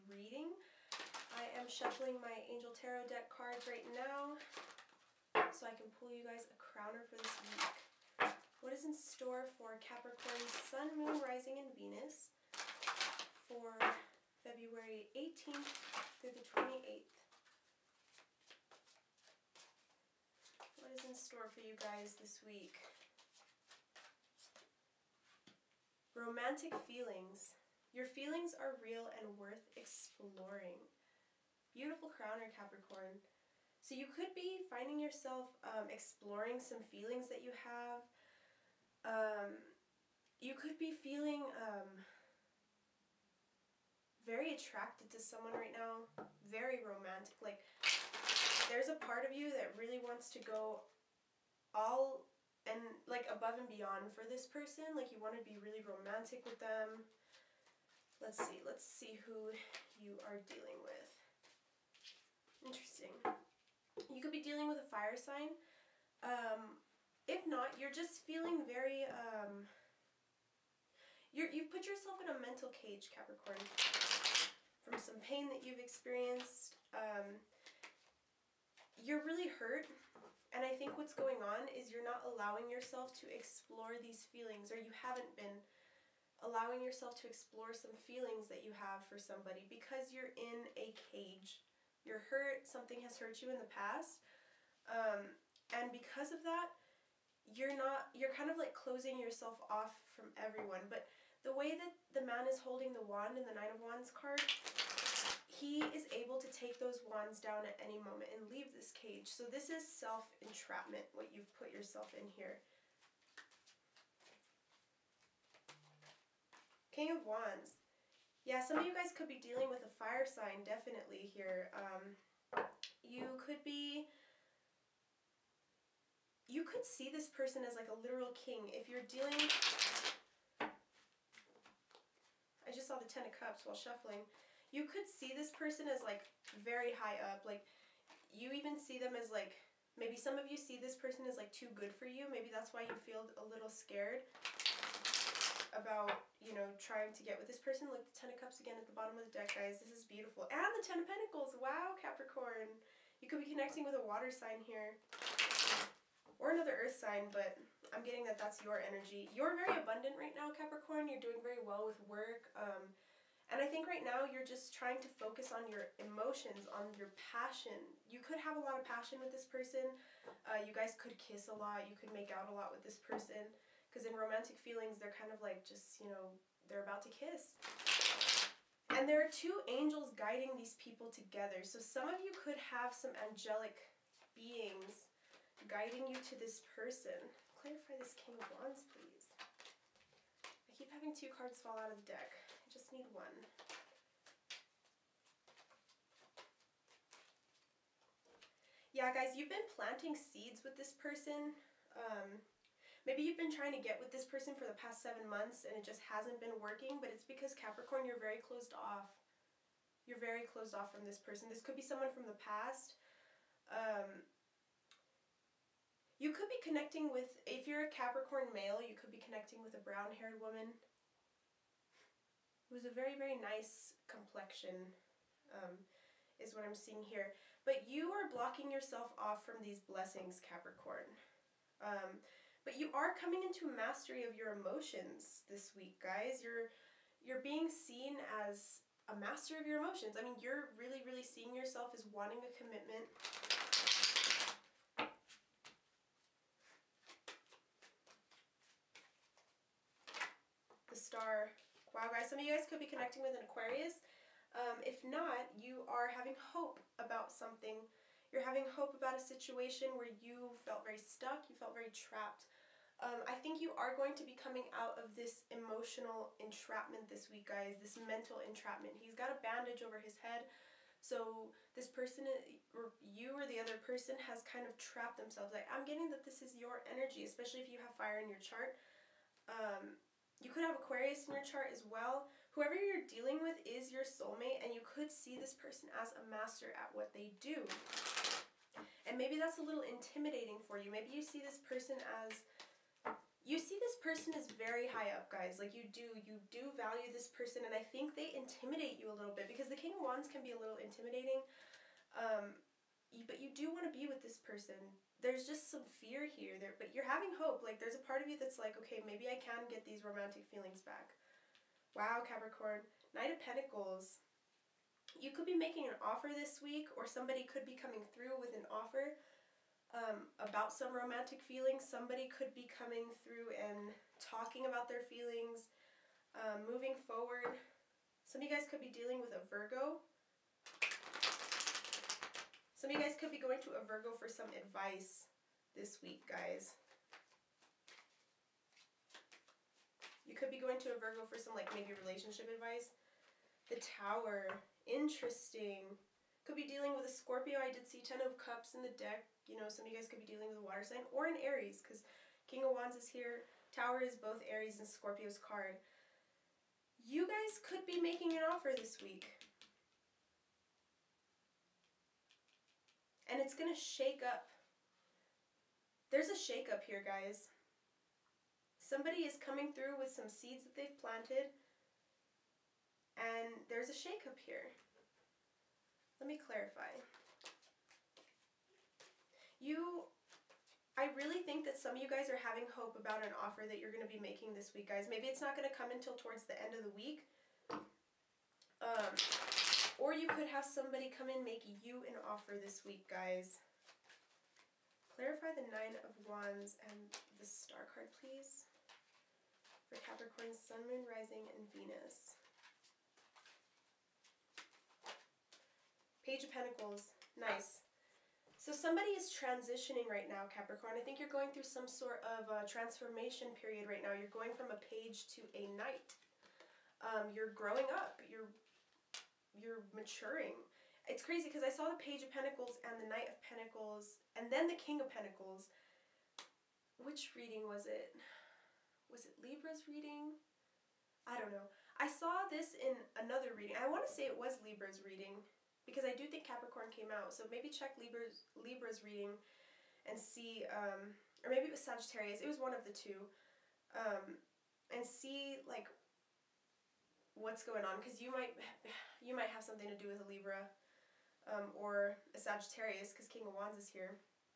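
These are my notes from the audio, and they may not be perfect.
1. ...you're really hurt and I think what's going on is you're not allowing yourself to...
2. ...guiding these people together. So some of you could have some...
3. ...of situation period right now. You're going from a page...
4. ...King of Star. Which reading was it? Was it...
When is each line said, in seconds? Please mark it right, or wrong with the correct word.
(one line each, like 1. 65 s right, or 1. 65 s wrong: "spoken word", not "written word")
1. 79 s right
2. 180 s right
3. 412 s wrong: "transformation", not "situation"
4. 424 s wrong: "Pentacles", not "Star".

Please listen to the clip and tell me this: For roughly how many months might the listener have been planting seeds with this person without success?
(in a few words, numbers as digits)
7.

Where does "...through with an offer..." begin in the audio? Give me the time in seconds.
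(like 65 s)
318 s.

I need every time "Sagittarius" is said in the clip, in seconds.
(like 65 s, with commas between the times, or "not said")
441 s, 452 s.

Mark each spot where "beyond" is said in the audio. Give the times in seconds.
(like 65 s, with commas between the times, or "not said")
53 s.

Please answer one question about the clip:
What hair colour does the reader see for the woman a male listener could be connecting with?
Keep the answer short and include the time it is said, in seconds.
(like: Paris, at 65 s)
Brown, at 219 s.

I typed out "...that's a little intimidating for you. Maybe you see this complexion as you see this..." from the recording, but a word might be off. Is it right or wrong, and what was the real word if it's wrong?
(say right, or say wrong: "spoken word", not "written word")
wrong: "person", not "complexion".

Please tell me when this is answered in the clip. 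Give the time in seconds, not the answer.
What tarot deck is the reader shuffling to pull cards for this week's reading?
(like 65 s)
2 s.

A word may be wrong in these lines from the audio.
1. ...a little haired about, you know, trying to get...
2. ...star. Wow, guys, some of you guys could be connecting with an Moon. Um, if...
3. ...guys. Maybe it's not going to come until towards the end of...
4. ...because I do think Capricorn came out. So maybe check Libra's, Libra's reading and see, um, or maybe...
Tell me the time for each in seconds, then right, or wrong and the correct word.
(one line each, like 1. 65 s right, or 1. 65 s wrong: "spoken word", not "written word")
1. 143 s wrong: "scared", not "haired"
2. 250 s wrong: "Aquarius", not "Moon"
3. 384 s right
4. 435 s right.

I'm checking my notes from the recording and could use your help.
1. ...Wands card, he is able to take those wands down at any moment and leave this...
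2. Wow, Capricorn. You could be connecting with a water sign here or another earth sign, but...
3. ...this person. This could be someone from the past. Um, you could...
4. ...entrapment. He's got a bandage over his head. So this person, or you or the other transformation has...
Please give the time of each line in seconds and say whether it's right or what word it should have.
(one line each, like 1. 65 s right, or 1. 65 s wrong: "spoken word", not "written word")
1. 103 s right
2. 151 s right
3. 211 s right
4. 268 s wrong: "person", not "transformation".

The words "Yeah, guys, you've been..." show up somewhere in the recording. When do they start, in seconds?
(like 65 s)
198 s.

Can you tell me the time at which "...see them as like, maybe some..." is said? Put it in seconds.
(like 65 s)
138 s.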